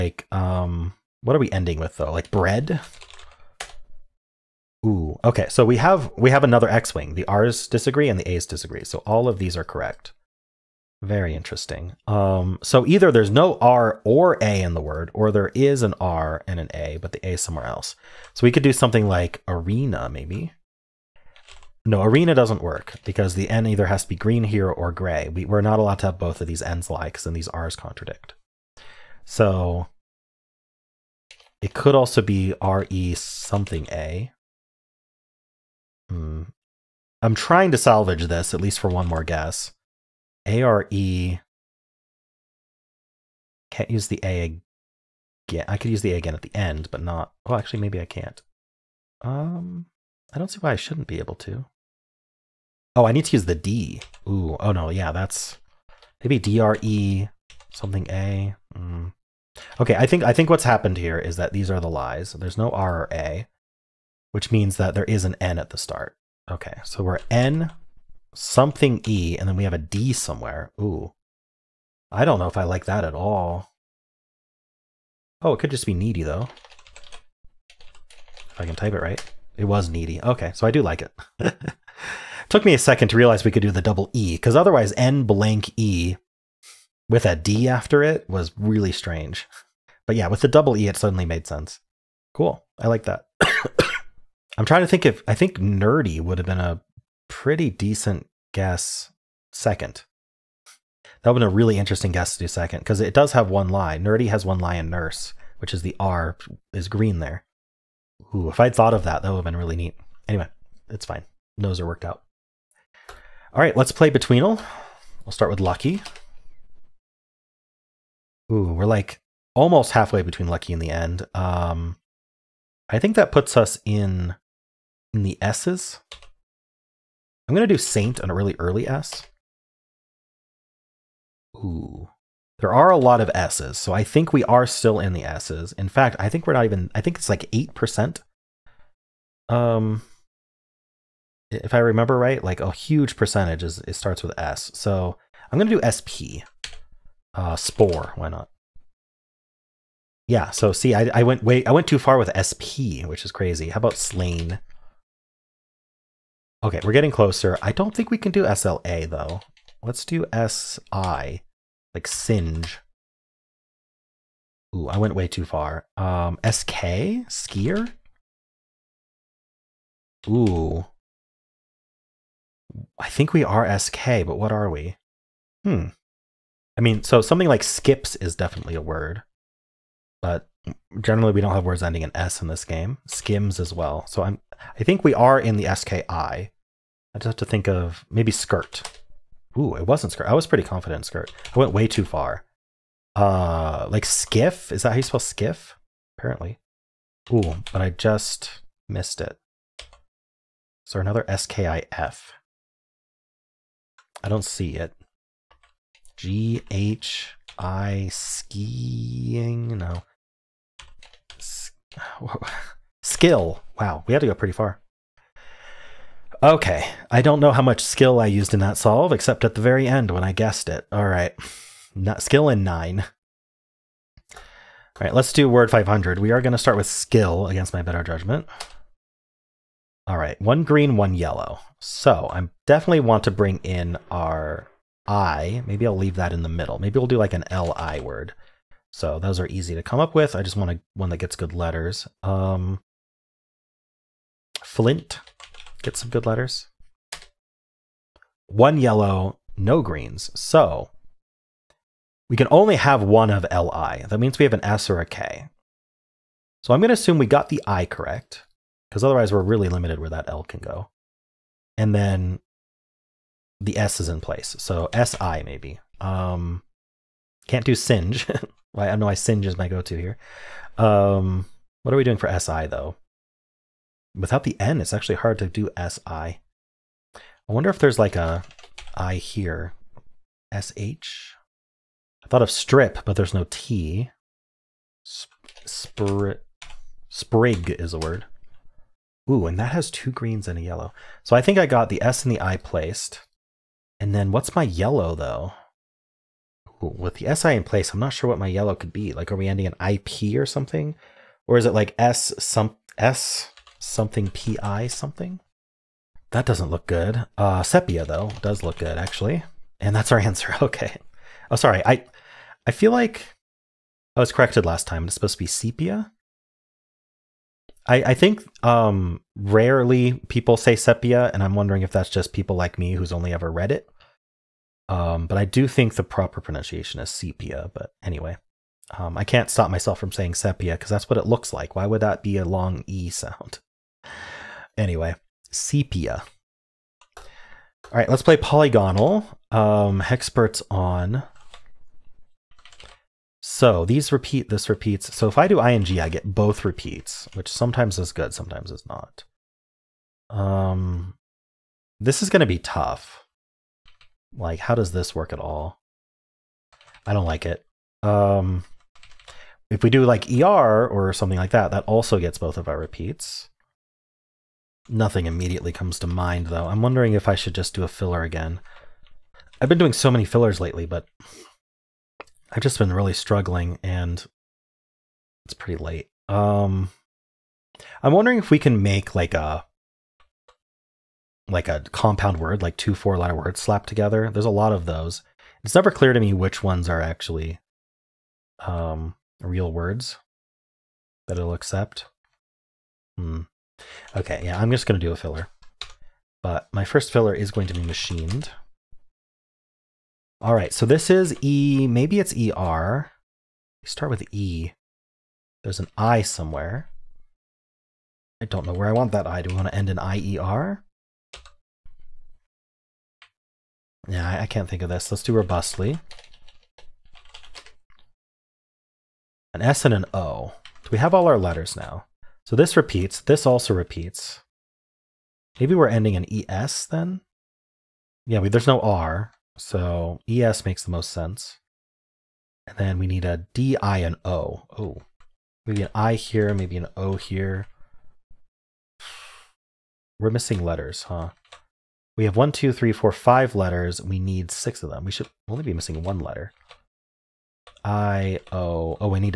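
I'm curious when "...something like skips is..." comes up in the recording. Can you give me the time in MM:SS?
02:57.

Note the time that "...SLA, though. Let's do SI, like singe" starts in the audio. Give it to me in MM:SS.
02:38.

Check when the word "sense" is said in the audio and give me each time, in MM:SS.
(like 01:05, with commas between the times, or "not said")
01:31, 07:11.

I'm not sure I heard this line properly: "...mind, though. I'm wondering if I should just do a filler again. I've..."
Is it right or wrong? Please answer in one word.
right.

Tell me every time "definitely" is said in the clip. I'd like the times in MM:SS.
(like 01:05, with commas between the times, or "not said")
02:58, 03:52.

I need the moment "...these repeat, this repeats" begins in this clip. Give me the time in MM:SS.
05:43.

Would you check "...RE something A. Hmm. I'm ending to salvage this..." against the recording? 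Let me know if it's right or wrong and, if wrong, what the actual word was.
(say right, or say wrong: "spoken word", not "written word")
wrong: "trying", not "ending".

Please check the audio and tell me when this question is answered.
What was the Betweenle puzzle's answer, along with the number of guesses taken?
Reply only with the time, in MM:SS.
03:42.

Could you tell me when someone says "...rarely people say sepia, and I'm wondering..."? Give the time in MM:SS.
05:19.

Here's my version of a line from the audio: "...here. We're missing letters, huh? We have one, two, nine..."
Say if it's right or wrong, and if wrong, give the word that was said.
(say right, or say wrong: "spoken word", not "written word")
wrong: "three", not "nine".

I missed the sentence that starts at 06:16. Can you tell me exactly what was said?
Um, I'm wondering if we can make like a like a compound word, like two four-letter words slapped together.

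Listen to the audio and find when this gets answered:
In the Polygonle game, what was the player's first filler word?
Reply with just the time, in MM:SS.
06:37.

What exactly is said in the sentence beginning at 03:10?
I was pretty confident in skirt.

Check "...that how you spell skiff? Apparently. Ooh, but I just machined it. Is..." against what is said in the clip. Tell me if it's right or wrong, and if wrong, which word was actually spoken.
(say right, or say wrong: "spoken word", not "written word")
wrong: "missed", not "machined".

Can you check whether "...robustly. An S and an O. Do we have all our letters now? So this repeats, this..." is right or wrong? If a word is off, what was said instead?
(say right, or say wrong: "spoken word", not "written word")
right.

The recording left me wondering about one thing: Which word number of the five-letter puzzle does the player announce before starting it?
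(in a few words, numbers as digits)
500.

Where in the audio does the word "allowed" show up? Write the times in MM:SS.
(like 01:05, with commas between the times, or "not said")
00:25.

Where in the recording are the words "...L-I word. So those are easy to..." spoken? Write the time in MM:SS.
03:57.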